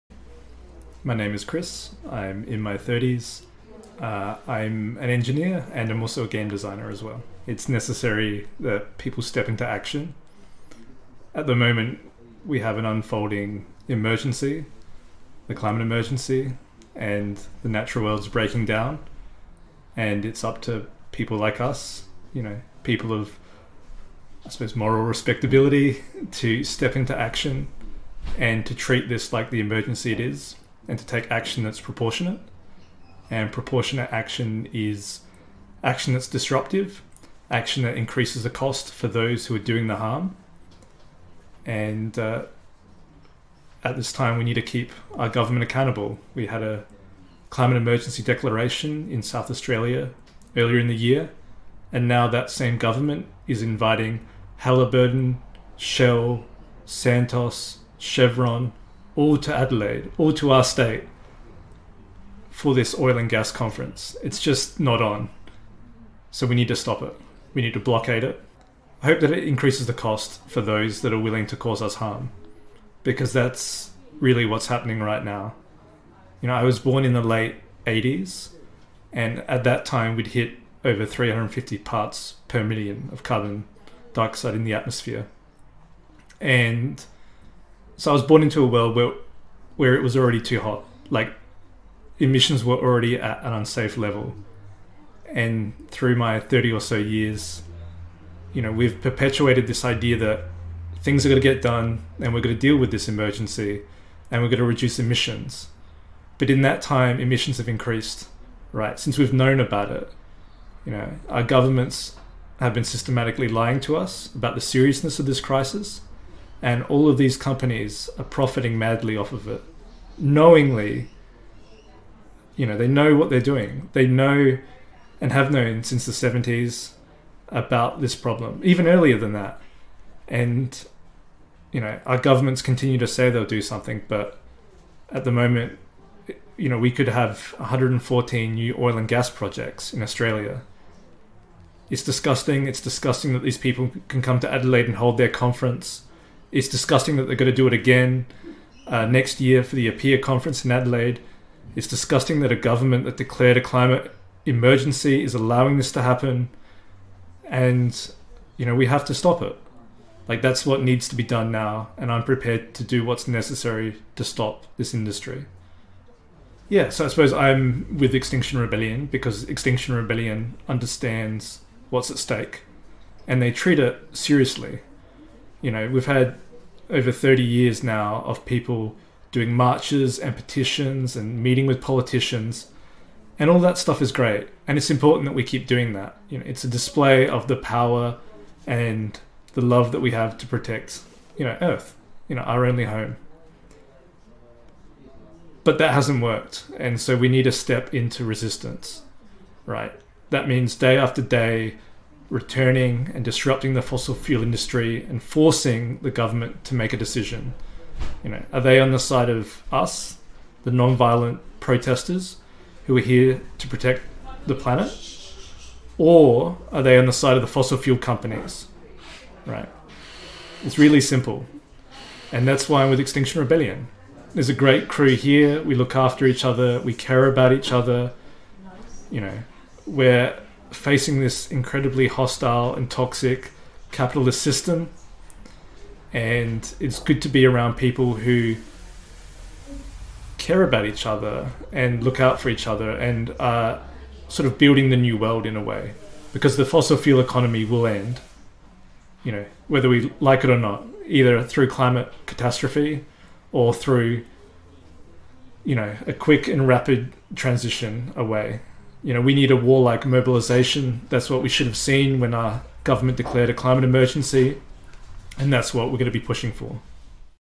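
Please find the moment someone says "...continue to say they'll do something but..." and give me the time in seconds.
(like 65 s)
132 s.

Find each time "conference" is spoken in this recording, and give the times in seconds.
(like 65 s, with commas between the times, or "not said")
63 s, 145 s, 150 s.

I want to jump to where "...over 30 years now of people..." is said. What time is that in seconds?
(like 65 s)
176 s.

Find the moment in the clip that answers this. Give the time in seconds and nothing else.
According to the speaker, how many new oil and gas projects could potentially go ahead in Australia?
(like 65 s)
137 s.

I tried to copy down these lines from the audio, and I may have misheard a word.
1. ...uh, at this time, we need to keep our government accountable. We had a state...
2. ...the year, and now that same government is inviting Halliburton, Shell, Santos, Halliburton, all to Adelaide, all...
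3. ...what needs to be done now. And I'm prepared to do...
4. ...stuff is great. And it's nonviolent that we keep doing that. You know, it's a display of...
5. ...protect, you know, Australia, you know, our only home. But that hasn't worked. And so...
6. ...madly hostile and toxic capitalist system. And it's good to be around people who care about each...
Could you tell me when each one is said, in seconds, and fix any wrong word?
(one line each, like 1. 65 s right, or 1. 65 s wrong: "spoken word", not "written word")
1. 42 s wrong: "climate", not "state"
2. 50 s wrong: "Chevron", not "Halliburton"
3. 160 s right
4. 183 s wrong: "important", not "nonviolent"
5. 190 s wrong: "Earth", not "Australia"
6. 231 s wrong: "incredibly", not "madly".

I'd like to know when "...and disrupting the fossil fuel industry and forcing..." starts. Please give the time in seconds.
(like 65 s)
203 s.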